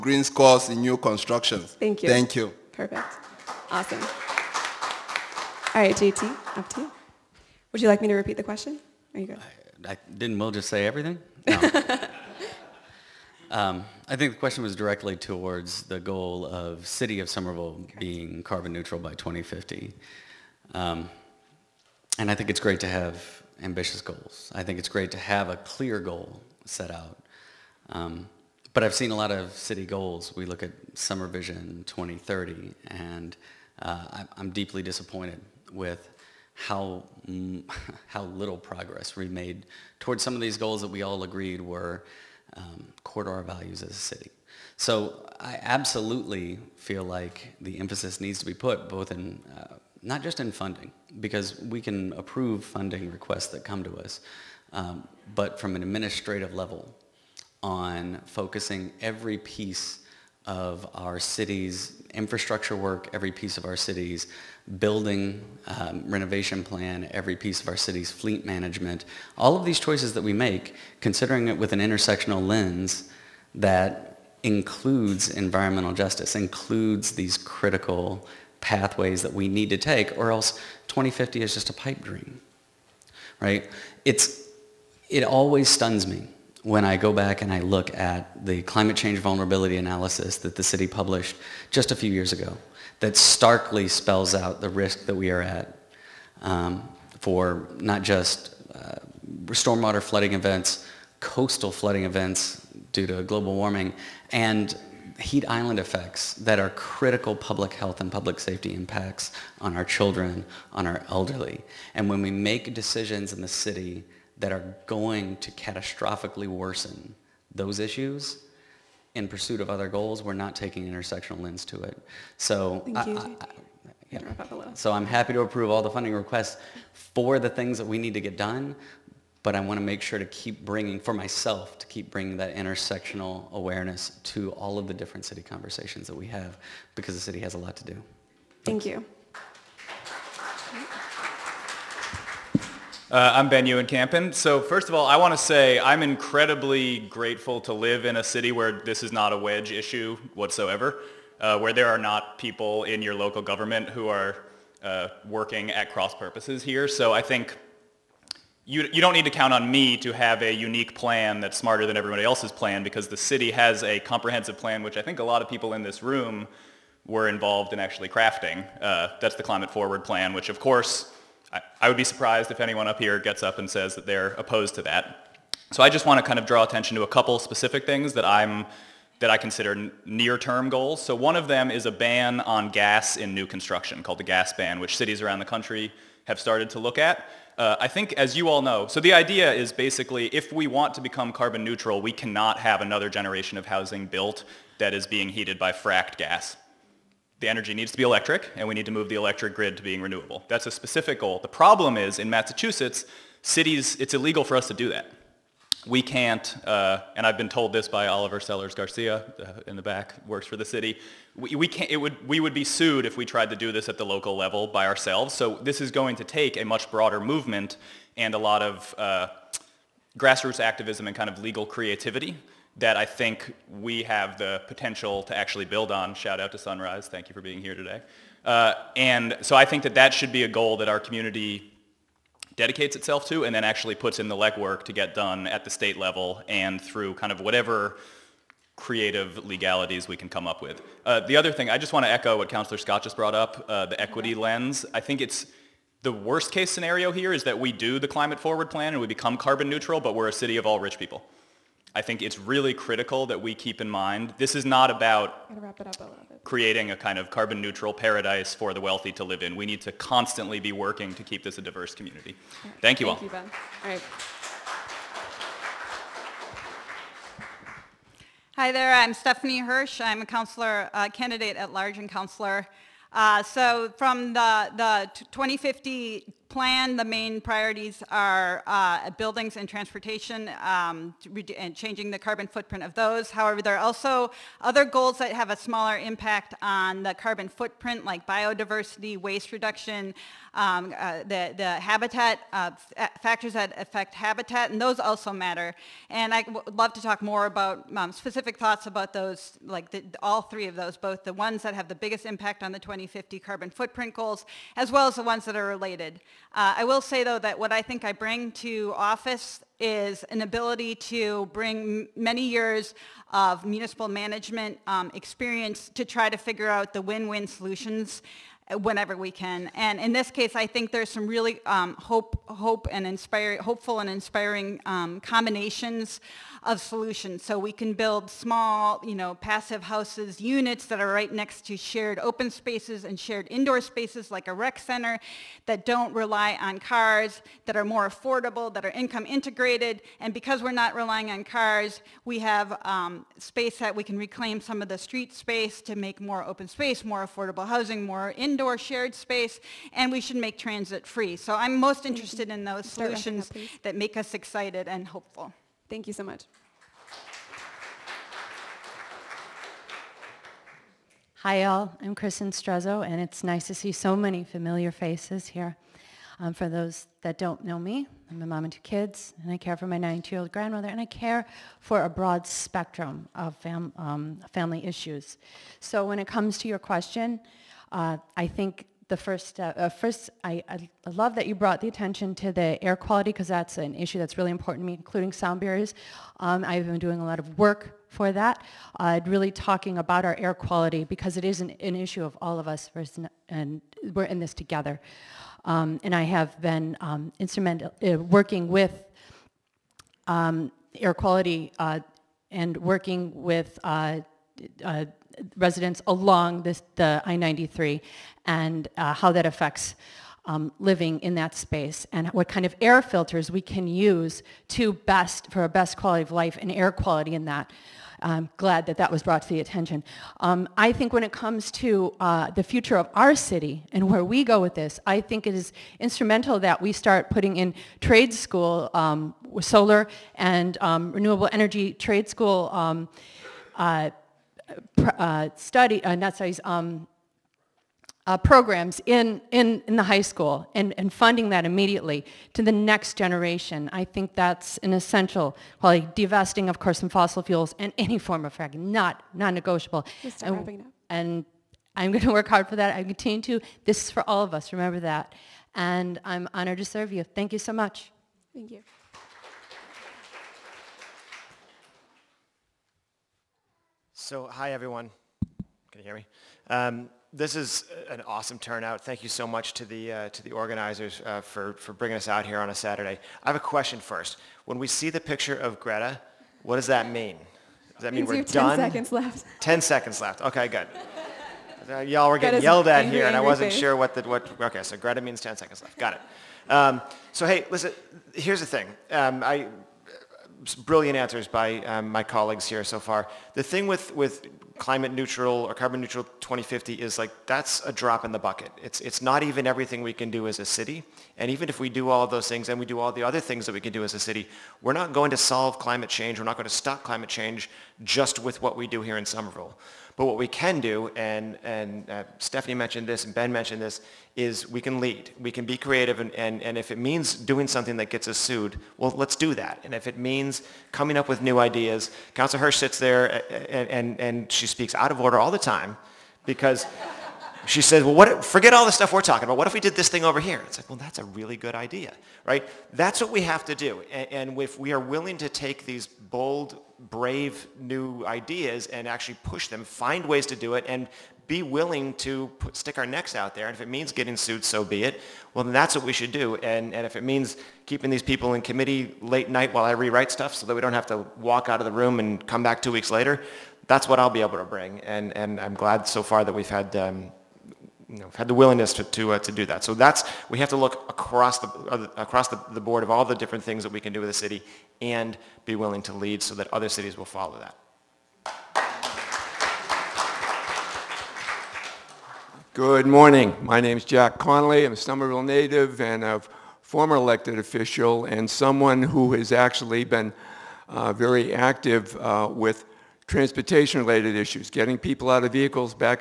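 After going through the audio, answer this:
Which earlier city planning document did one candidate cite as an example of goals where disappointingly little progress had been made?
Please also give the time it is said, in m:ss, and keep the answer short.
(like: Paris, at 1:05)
SomerVision 2030, at 0:30.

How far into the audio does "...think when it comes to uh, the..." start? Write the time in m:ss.
7:00.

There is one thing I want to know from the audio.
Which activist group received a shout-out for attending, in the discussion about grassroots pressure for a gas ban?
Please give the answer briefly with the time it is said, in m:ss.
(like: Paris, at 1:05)
Sunrise, at 3:46.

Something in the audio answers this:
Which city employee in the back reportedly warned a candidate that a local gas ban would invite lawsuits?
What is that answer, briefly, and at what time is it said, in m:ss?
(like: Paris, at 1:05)
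Oliver Sellers Garcia, at 3:28.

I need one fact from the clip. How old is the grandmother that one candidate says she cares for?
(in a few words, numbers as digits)
92.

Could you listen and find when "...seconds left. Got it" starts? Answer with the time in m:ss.
8:05.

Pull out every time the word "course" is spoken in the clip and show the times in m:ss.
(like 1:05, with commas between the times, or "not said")
2:50, 7:26.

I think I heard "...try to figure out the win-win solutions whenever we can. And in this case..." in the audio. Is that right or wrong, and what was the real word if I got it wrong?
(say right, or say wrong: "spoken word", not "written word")
right.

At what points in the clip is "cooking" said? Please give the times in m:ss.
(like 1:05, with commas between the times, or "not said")
not said.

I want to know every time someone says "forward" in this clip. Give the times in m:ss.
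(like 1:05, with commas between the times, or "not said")
2:49, 4:08.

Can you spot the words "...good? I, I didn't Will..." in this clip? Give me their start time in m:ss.
0:09.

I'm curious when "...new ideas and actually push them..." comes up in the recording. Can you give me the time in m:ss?
8:57.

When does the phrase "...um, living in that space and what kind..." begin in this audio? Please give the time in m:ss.
6:50.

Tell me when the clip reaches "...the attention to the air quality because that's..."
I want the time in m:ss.
6:21.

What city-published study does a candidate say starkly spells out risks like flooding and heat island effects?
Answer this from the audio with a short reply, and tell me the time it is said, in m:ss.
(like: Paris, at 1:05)
climate change vulnerability analysis, at 1:28.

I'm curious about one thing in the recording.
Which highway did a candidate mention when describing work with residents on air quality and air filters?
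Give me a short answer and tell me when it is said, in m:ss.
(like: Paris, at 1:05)
I-93, at 6:47.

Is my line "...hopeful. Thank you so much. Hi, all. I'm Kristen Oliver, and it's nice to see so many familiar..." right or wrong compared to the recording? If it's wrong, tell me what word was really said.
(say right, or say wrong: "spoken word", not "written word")
wrong: "Strezo", not "Oliver".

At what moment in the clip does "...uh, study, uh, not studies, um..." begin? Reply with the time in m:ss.
7:15.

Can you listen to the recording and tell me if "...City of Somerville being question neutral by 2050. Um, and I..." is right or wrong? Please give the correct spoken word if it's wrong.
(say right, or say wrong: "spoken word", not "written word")
wrong: "carbon", not "question".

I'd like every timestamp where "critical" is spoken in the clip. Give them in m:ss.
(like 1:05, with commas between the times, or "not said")
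1:17, 1:46, 4:12.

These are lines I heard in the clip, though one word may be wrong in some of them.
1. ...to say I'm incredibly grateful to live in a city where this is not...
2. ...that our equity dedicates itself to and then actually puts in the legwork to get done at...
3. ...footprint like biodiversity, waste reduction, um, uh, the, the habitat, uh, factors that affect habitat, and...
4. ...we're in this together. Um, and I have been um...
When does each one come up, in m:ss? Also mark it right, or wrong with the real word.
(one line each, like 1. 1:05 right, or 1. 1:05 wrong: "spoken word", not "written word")
1. 2:25 right
2. 3:50 wrong: "community", not "equity"
3. 4:47 right
4. 6:34 right.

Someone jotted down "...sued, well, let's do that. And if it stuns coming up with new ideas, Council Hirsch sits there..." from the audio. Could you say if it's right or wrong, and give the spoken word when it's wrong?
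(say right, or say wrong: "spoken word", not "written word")
wrong: "means", not "stuns".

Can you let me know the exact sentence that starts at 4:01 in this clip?
Uh, the other thing, I just want to echo what Councillor Scott just brought up, uh, the equity lens.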